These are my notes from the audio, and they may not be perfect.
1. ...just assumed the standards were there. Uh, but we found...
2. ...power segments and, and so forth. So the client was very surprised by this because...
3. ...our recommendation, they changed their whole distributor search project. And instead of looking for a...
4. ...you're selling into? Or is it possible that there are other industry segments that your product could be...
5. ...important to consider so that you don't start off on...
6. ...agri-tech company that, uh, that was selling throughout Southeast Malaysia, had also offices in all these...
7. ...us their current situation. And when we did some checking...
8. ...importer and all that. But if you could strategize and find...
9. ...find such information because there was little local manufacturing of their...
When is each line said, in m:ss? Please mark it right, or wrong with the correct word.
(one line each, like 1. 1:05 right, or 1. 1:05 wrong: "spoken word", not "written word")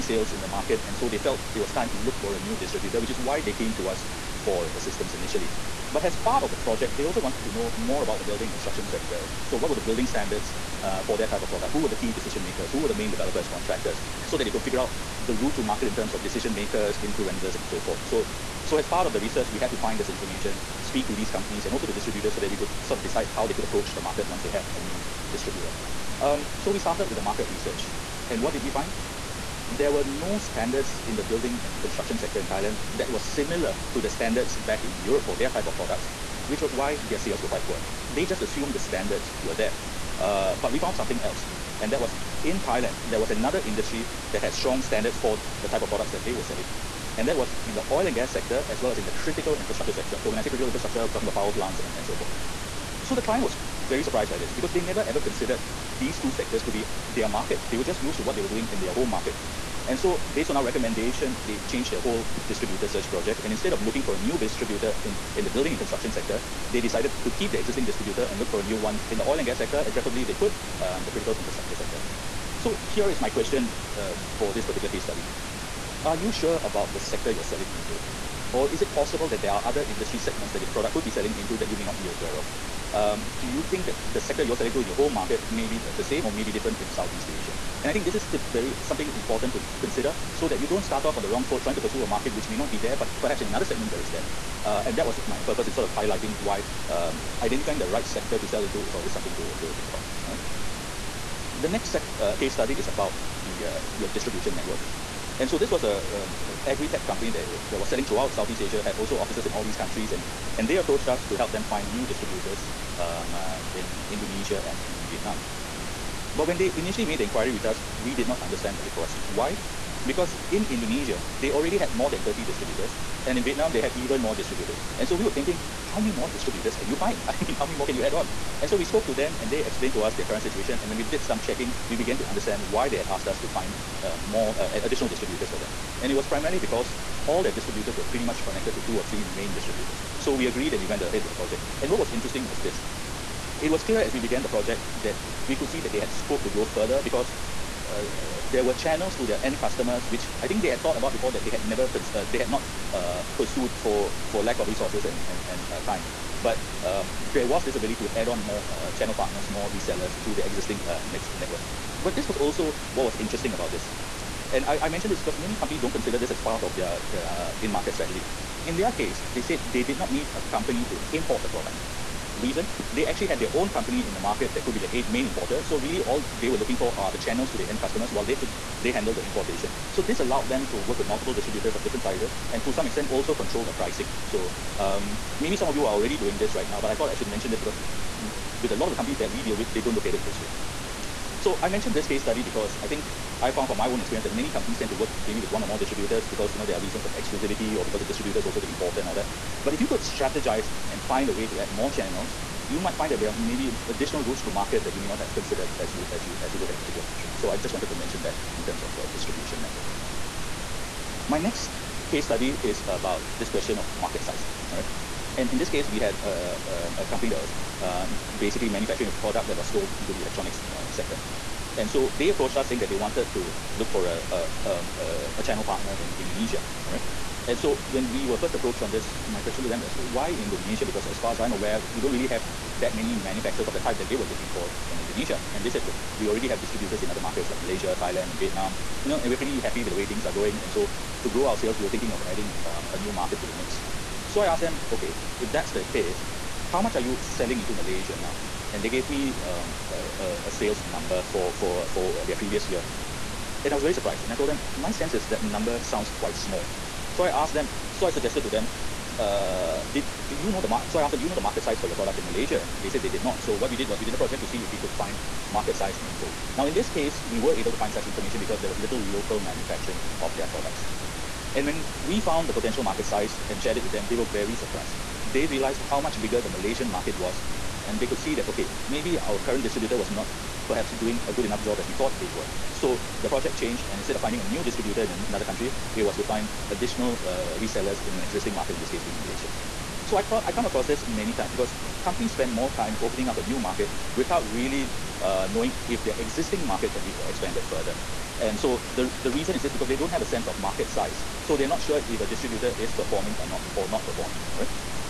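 1. 0:38 right
2. 0:51 wrong: "plants", not "segments"
3. 1:00 right
4. 1:17 right
5. 1:29 right
6. 1:46 wrong: "Asia", not "Malaysia"
7. 2:10 right
8. 3:18 right
9. 4:27 right.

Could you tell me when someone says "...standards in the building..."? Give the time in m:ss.
0:30.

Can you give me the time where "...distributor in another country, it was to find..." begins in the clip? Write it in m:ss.
4:44.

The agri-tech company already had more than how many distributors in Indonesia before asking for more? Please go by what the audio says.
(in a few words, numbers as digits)
30.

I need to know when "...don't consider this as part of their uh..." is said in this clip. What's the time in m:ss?
2:45.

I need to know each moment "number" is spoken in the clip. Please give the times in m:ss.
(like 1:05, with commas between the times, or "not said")
4:10, 4:15.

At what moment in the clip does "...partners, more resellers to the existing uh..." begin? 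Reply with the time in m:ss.
2:39.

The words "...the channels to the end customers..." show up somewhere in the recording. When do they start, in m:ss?
2:57.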